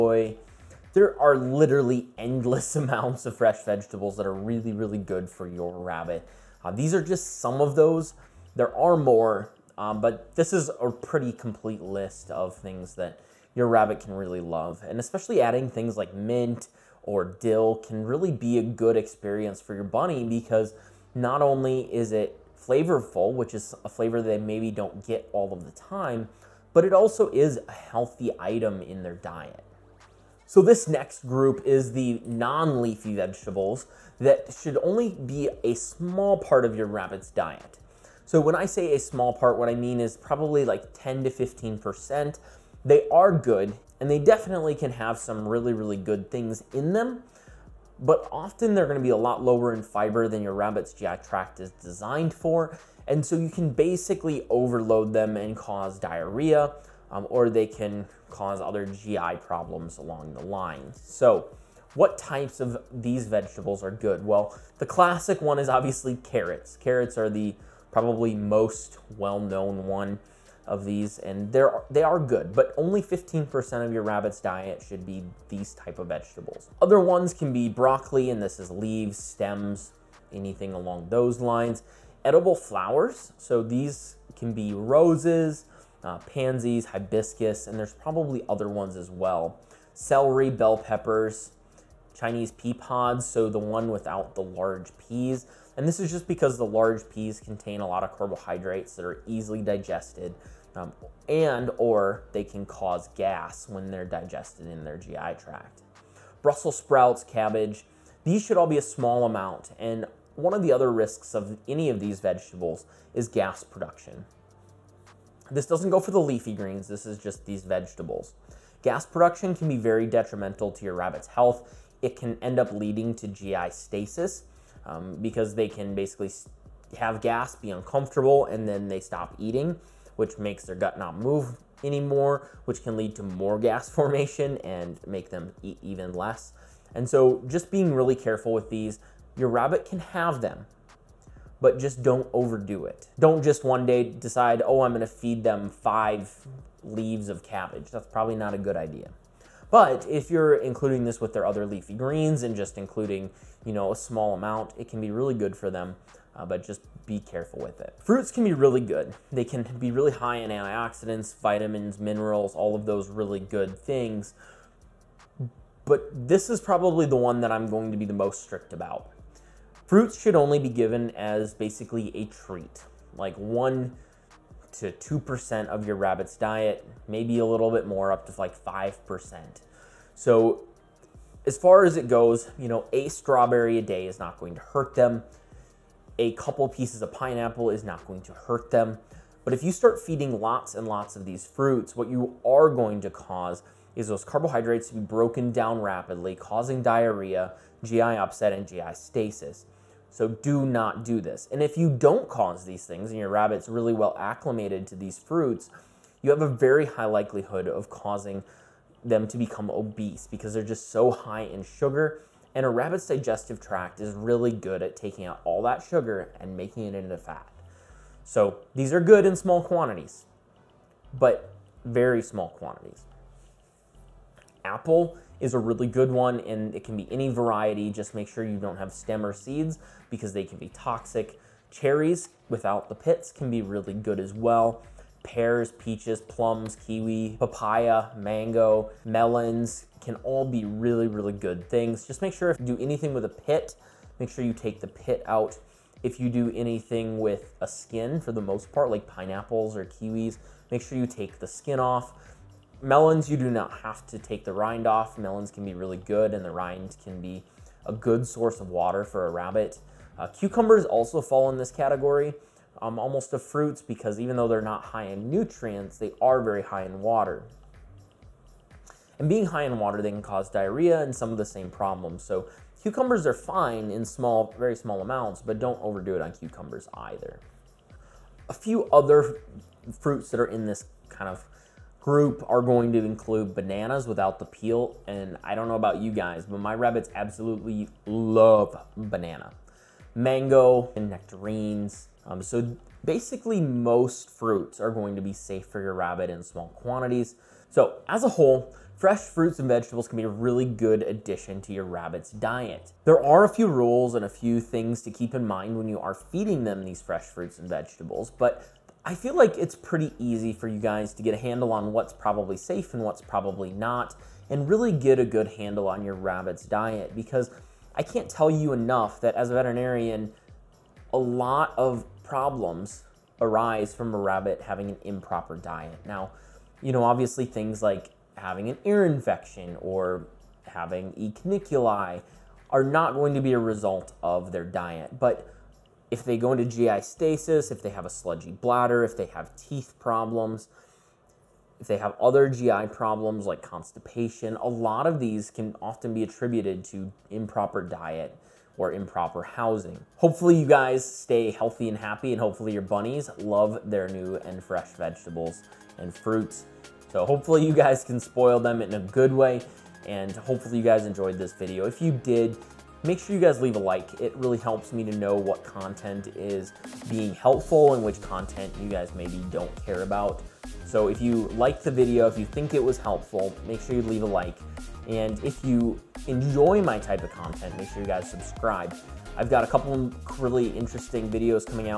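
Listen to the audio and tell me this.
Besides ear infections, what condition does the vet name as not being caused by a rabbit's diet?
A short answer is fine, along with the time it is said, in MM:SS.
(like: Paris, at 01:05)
E. cuniculi, at 05:31.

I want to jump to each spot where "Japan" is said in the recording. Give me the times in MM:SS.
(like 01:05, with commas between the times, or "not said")
not said.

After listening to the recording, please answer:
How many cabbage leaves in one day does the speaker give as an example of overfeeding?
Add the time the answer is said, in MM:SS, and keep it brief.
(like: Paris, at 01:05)
5, at 02:25.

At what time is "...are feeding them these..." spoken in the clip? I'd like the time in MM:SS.
05:05.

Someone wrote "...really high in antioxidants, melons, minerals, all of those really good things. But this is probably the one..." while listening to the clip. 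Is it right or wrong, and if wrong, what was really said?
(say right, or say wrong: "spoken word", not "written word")
wrong: "vitamins", not "melons".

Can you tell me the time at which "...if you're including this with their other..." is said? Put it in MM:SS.
02:30.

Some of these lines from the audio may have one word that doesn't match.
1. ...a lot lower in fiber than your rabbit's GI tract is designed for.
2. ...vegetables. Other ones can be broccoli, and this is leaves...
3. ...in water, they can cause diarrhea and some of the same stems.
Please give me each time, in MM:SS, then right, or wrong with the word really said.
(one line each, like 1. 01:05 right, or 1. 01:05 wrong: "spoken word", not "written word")
1. 00:49 right
2. 01:16 right
3. 04:29 wrong: "problems", not "stems".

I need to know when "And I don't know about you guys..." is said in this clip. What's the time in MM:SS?
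04:45.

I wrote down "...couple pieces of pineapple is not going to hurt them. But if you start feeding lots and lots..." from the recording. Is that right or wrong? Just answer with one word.
right.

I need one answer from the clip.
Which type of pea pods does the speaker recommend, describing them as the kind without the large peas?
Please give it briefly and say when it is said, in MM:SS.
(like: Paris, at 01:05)
Chinese pea pods, at 01:32.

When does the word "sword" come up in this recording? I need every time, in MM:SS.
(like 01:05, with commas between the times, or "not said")
not said.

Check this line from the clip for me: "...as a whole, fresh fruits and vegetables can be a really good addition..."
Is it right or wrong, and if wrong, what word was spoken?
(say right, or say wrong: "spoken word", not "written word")
right.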